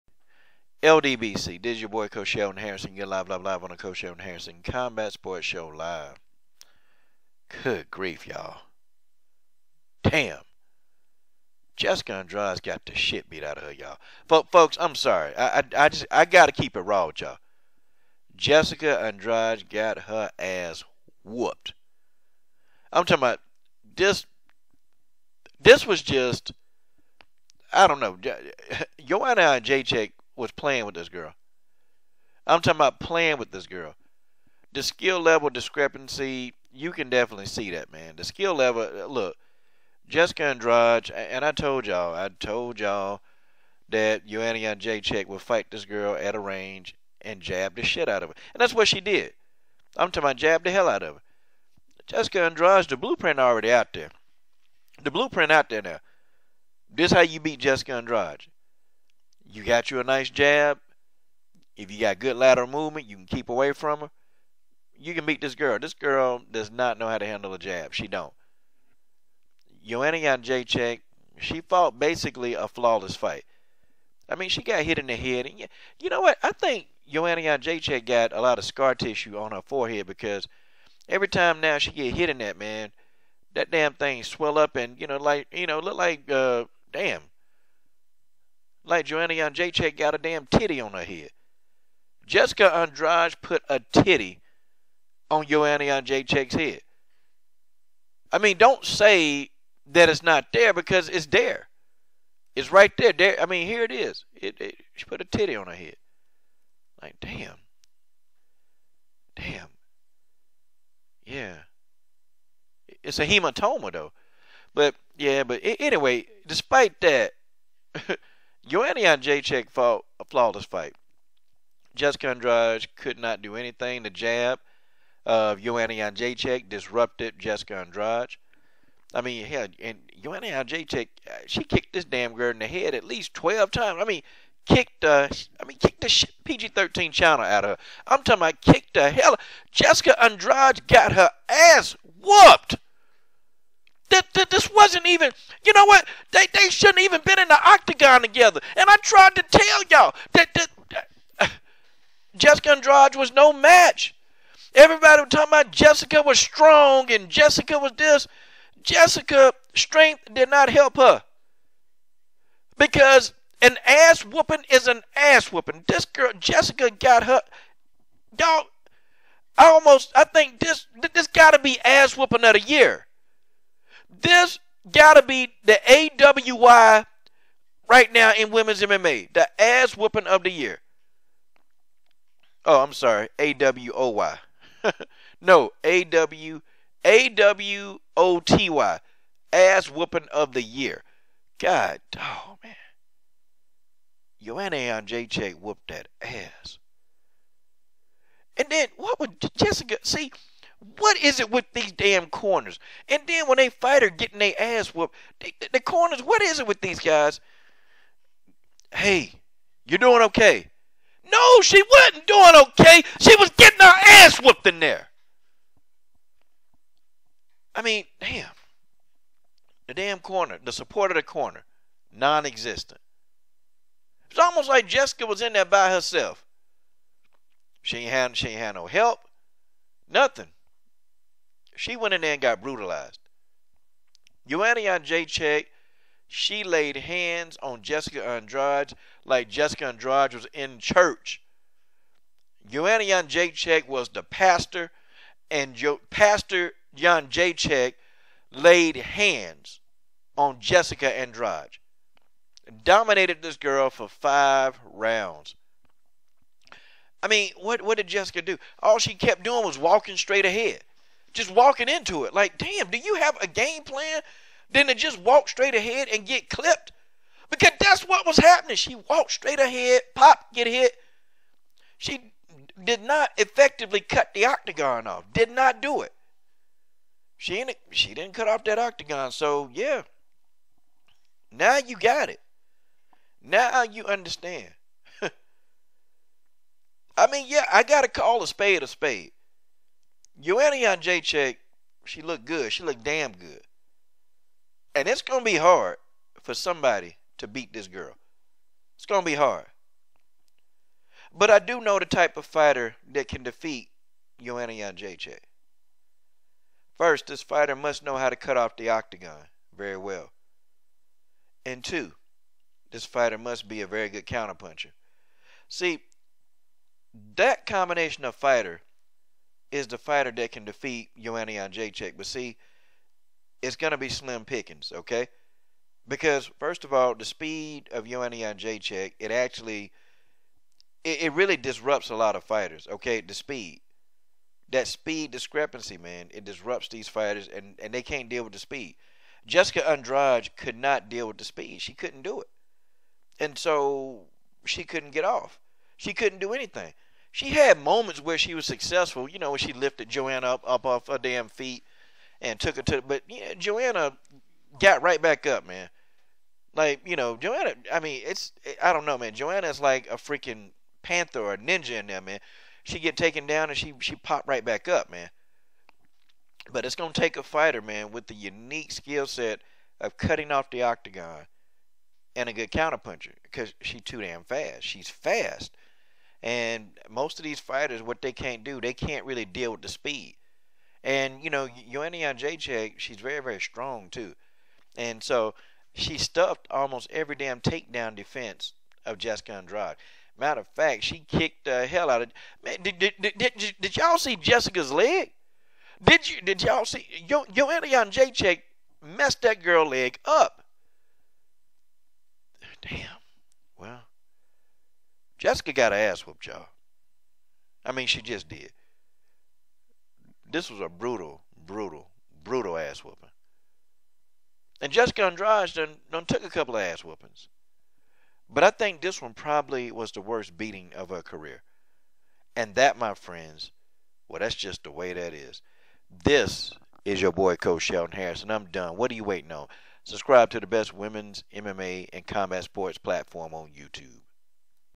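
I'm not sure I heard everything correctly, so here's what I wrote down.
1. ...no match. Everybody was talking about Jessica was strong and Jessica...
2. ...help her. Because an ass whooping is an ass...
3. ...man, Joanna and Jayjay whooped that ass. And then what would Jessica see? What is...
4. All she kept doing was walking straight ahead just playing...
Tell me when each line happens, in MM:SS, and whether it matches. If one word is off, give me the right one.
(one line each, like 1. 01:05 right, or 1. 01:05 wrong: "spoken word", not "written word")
1. 02:33 right
2. 02:40 right
3. 03:12 right
4. 04:18 wrong: "walking", not "playing".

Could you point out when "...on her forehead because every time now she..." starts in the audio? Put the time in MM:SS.
01:19.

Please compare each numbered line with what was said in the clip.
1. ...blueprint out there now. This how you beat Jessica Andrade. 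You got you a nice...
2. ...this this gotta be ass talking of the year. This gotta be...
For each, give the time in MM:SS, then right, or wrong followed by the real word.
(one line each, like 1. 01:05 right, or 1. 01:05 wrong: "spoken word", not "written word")
1. 00:55 right
2. 02:50 wrong: "whooping", not "talking".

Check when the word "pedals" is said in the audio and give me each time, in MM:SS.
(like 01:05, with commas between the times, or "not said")
not said.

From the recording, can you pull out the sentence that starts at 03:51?
She went in there and got brutalized.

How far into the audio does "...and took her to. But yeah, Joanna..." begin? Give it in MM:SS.
05:52.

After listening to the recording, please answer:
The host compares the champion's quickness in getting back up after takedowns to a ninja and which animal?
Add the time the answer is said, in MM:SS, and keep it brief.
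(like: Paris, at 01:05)
panther, at 06:01.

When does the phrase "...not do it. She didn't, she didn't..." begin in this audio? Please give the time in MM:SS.
04:35.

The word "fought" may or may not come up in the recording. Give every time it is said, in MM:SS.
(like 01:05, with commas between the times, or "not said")
01:11, 01:59.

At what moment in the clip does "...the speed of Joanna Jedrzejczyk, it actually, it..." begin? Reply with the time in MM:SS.
05:27.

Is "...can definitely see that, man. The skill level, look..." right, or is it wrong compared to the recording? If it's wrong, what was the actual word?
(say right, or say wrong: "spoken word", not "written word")
right.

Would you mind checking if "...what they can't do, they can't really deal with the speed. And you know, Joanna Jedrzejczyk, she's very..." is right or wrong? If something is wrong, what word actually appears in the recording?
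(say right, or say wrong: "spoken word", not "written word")
right.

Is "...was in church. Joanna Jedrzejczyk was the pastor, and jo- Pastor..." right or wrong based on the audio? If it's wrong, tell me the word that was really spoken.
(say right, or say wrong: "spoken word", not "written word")
right.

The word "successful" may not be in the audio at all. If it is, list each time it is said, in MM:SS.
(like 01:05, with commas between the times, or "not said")
05:48.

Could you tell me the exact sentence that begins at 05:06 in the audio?
First, this fighter must know how to cut off the octagon very well.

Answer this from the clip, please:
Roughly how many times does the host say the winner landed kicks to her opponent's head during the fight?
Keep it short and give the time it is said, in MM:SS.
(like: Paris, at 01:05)
12, at 02:13.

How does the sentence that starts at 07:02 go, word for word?
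And that, my friends, well, that's just the way that is.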